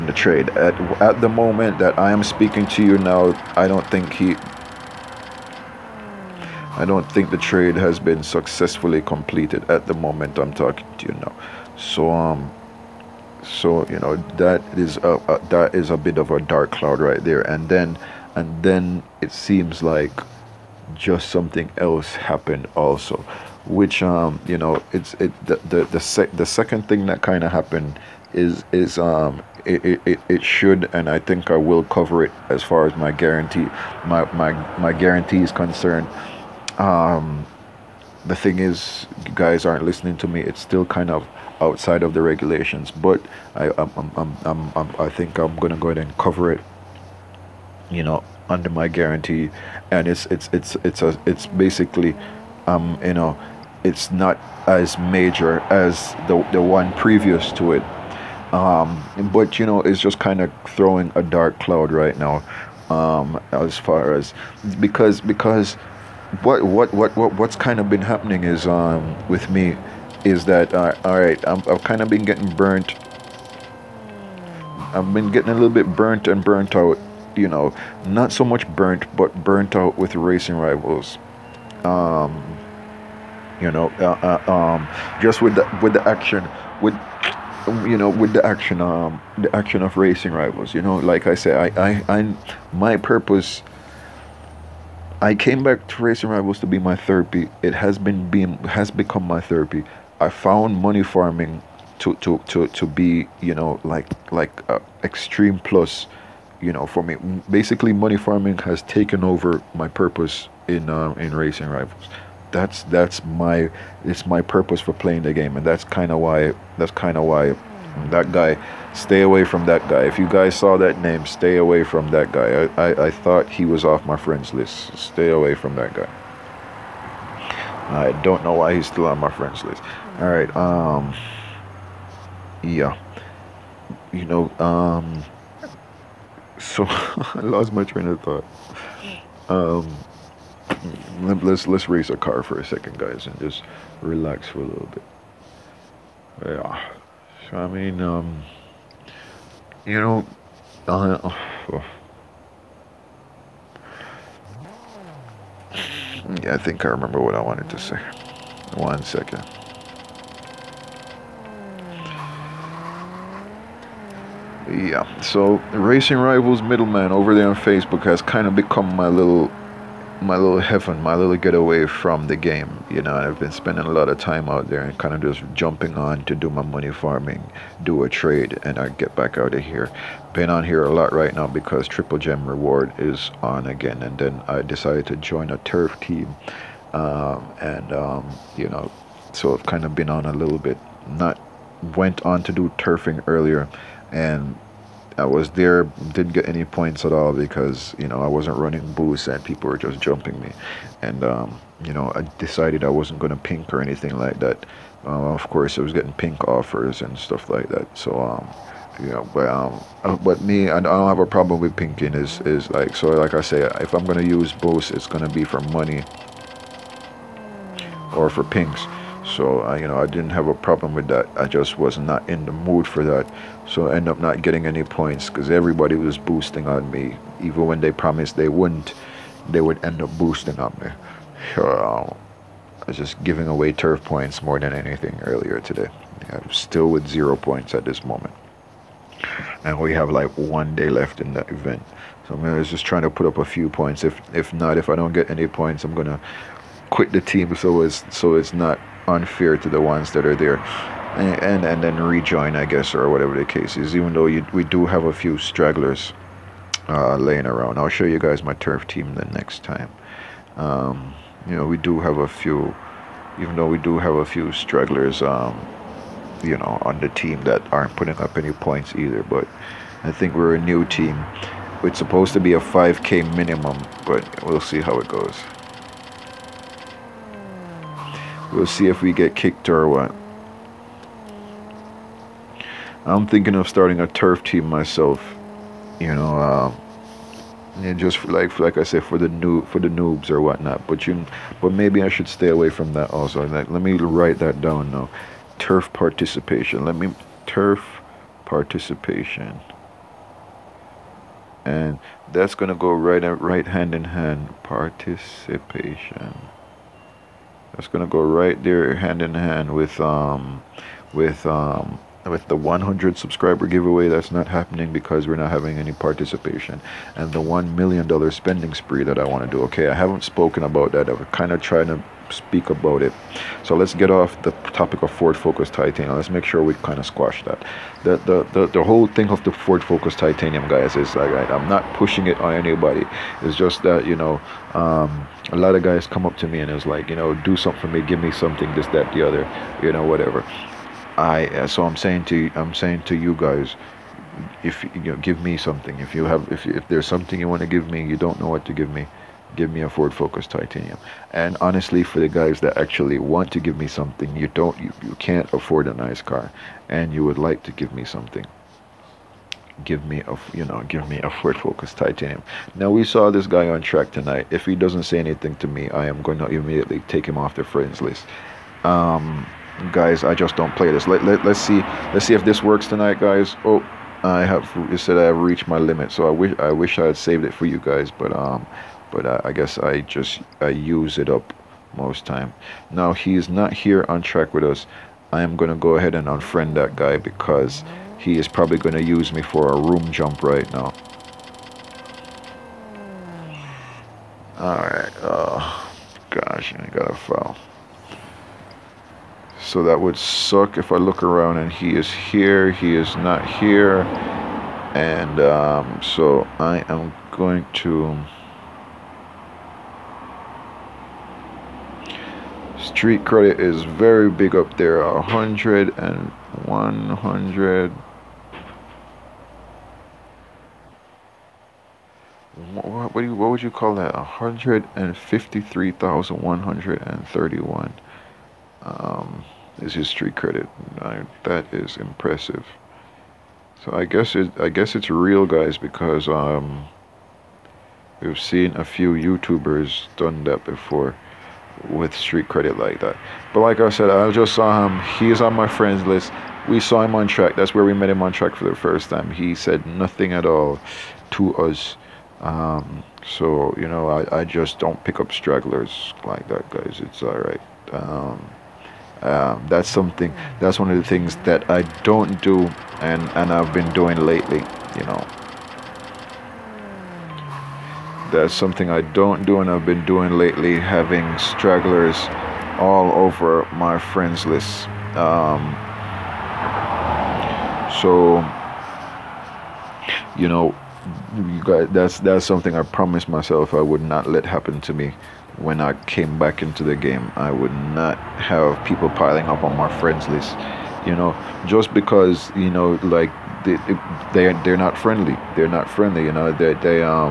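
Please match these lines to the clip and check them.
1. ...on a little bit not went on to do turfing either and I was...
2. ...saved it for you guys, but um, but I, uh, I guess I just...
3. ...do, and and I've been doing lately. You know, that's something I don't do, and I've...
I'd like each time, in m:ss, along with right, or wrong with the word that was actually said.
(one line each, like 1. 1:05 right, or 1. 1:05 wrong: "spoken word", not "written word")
1. 3:10 wrong: "earlier", not "either"
2. 6:17 right
3. 7:42 right.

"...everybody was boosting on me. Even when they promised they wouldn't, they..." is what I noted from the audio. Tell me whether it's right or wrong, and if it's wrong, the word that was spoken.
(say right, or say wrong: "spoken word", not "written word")
right.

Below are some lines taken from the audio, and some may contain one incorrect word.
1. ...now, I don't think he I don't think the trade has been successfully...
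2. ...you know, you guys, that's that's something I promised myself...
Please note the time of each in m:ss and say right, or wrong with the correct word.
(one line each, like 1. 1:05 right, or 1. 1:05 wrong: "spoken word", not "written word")
1. 0:02 right
2. 8:00 right.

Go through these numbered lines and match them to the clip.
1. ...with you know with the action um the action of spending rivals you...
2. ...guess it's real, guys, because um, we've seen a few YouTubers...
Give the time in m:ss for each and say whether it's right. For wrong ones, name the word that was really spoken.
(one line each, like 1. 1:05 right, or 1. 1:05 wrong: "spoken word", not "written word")
1. 1:26 wrong: "racing", not "spending"
2. 7:14 right.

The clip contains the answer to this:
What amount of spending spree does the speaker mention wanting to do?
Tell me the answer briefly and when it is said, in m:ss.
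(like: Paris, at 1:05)
1 million dollar, at 5:17.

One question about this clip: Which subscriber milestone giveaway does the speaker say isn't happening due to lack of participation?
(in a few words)
100 subscriber giveaway.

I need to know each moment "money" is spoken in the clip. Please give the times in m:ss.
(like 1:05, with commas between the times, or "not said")
1:40, 1:47, 2:56, 3:35.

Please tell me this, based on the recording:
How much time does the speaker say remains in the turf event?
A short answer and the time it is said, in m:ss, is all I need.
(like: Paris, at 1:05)
one day, at 4:00.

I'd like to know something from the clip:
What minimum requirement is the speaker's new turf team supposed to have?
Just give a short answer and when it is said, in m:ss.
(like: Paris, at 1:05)
5k, at 4:32.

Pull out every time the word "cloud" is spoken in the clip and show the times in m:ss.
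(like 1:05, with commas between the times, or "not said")
0:16, 1:01.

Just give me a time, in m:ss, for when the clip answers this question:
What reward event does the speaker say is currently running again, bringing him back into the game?
3:01.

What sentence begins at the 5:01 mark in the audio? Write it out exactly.
And that's gonna go right right hand in hand.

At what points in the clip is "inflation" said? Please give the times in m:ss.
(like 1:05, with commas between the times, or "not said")
not said.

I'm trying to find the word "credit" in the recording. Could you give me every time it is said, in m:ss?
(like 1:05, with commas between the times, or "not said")
6:53, 7:10, 7:22.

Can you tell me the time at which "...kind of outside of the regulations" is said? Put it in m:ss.
0:40.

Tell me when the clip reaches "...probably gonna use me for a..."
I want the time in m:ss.
6:28.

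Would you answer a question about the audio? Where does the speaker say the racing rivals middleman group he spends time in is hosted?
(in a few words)
Facebook.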